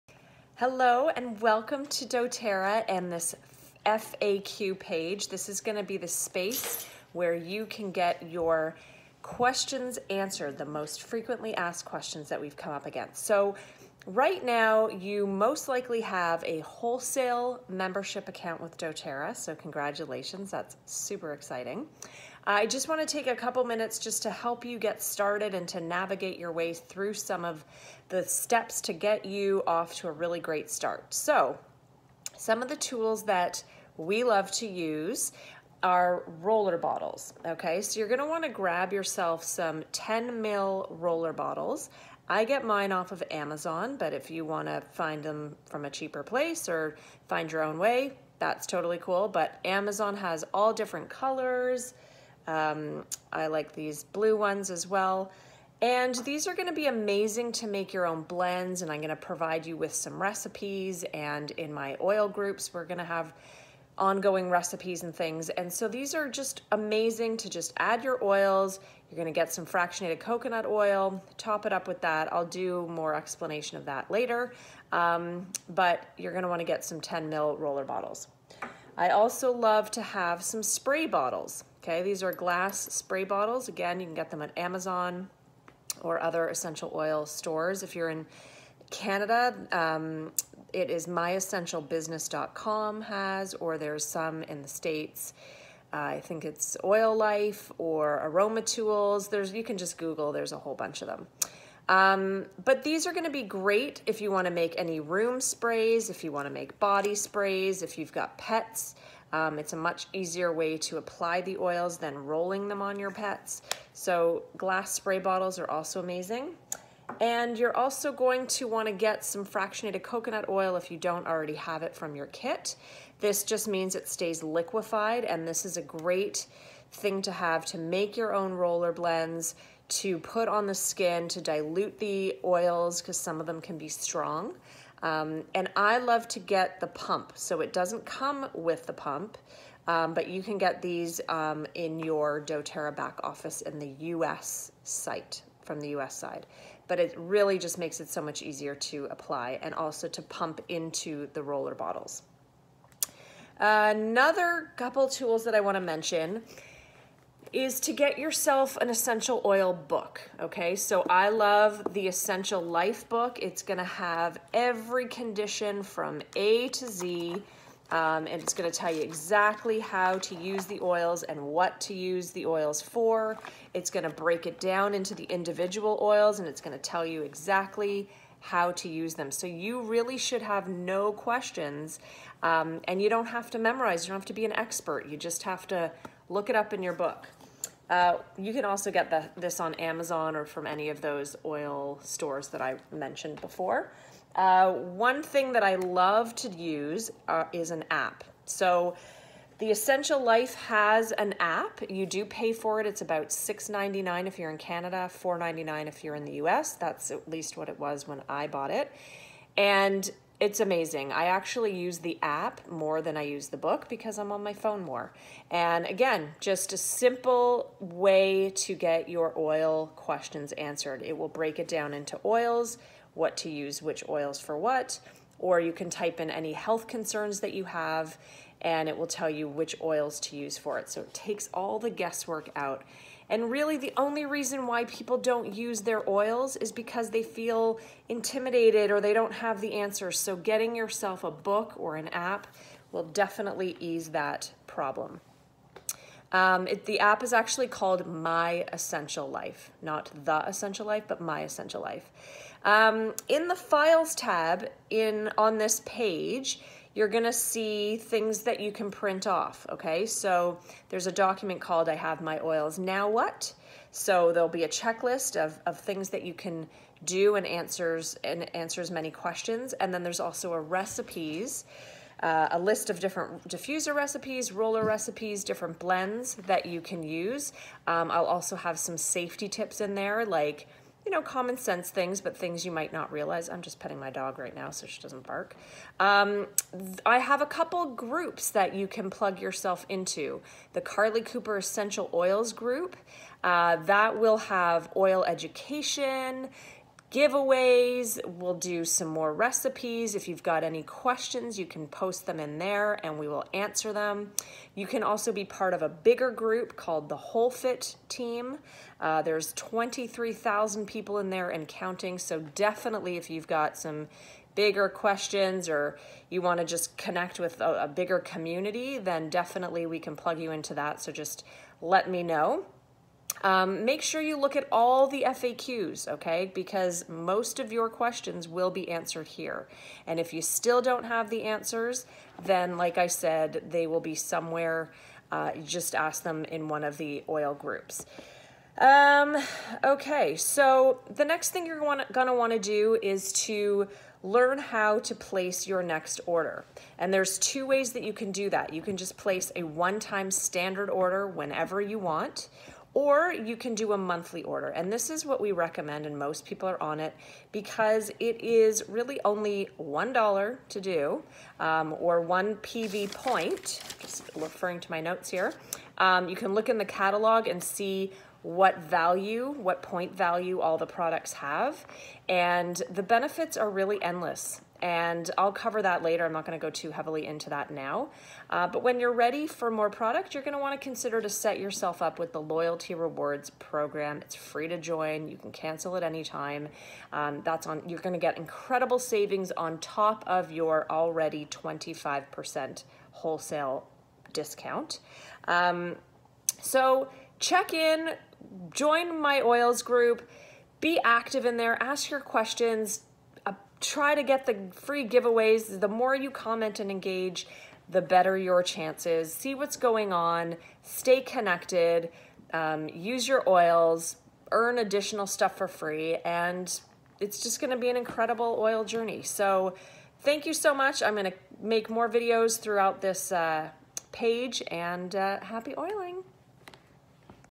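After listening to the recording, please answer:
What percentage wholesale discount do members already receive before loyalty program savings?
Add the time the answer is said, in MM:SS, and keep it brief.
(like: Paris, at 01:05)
25%, at 06:31.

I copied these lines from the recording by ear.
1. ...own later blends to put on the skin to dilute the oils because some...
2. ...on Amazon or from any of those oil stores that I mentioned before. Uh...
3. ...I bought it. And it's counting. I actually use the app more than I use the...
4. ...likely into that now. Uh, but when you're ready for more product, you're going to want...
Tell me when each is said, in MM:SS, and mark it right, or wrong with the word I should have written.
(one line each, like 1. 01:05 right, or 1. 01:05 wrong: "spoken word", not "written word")
1. 02:08 wrong: "roller", not "later"
2. 03:09 right
3. 03:28 wrong: "amazing", not "counting"
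4. 06:16 wrong: "heavily", not "likely".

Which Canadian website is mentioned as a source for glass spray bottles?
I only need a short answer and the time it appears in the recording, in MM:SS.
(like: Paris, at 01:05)
myessentialbusiness.com, at 01:31.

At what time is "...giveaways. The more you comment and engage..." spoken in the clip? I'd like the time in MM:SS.
06:45.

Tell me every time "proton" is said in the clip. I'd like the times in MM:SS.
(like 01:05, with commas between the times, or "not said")
not said.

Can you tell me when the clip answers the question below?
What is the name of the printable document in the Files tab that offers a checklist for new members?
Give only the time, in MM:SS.
04:21.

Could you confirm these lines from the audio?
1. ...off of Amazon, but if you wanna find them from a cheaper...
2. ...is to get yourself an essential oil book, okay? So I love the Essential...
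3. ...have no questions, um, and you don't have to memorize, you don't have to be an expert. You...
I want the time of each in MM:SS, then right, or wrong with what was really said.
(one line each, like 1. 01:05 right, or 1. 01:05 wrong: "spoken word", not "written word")
1. 00:42 right
2. 02:37 right
3. 03:00 right.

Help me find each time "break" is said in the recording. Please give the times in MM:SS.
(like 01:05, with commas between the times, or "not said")
02:54, 03:41.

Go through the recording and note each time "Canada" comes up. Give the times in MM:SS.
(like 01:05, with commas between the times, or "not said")
01:28, 03:24.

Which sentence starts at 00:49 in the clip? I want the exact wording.
But Amazon has all different colors, um, I like these blue ones as well.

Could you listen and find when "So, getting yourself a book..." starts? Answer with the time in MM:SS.
04:00.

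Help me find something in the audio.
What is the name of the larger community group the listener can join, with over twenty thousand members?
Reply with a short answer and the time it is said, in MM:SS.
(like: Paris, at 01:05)
Whole Fit Team, at 05:07.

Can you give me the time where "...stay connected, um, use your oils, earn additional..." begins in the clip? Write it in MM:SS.
06:50.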